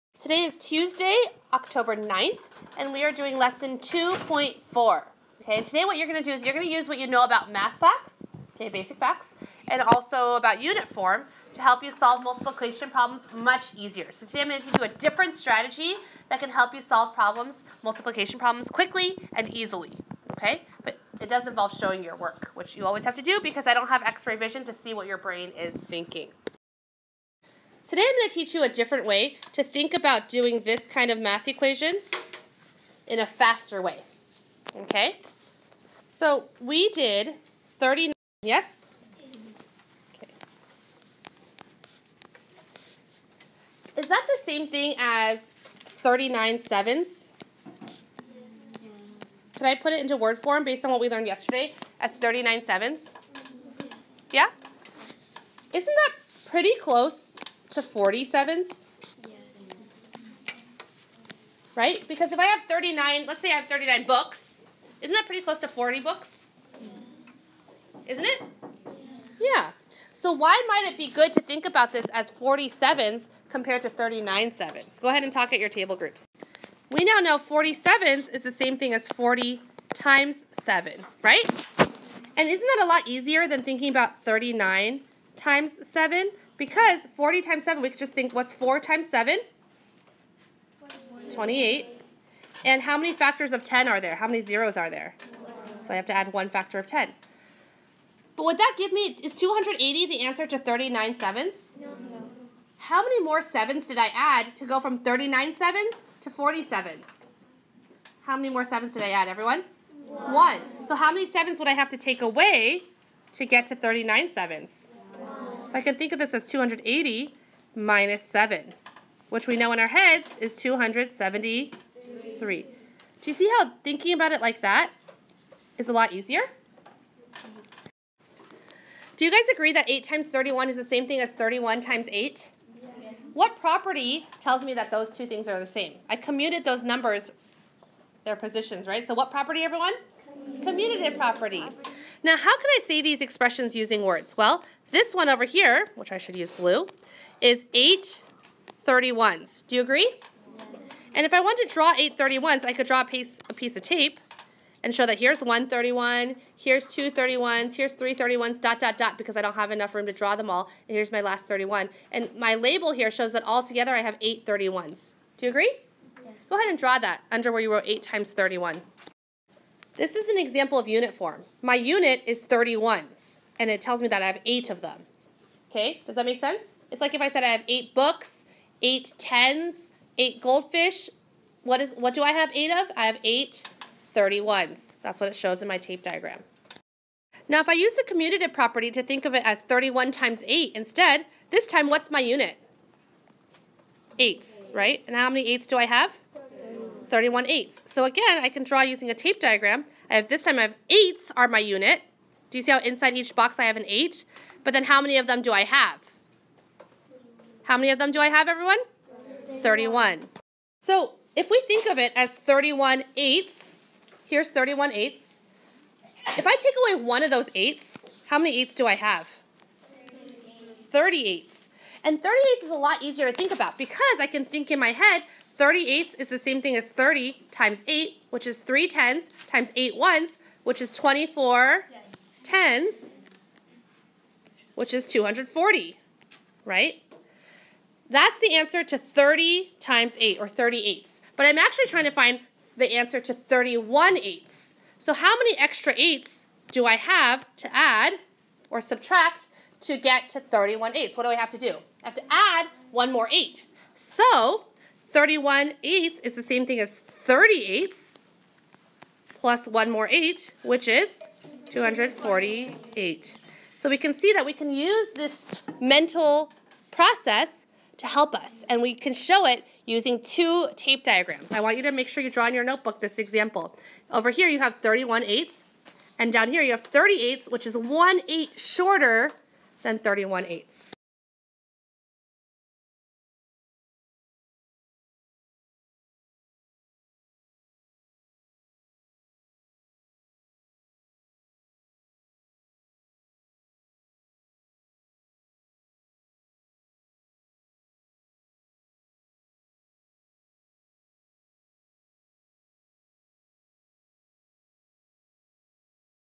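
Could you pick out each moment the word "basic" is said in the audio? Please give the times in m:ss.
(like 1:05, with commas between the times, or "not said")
0:08.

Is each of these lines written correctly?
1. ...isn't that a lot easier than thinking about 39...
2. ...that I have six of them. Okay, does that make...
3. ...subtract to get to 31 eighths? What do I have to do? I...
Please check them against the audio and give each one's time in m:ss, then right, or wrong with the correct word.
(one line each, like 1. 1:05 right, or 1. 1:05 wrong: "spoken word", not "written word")
1. 1:22 right
2. 2:54 wrong: "eight", not "six"
3. 4:08 right.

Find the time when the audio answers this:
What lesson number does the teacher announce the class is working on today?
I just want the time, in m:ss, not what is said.
0:03.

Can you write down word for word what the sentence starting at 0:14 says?
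So today I'm going to teach you a different strategy that can help you solve problems, multiplication problems, quickly and easily, okay?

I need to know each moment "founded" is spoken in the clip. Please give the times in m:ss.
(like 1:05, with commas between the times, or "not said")
not said.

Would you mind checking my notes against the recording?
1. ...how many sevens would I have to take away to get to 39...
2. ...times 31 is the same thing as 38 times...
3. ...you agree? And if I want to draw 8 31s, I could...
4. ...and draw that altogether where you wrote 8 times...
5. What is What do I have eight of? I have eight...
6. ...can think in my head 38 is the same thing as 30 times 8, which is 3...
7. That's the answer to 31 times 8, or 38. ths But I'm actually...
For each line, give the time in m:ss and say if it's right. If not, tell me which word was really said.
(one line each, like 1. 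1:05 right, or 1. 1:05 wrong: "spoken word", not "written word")
1. 1:50 right
2. 2:10 wrong: "31", not "38"
3. 2:29 right
4. 2:46 wrong: "under", not "altogether"
5. 3:01 right
6. 3:44 right
7. 3:58 wrong: "30", not "31".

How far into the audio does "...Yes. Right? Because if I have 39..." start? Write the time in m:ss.
0:59.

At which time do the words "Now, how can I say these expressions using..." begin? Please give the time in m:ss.
2:22.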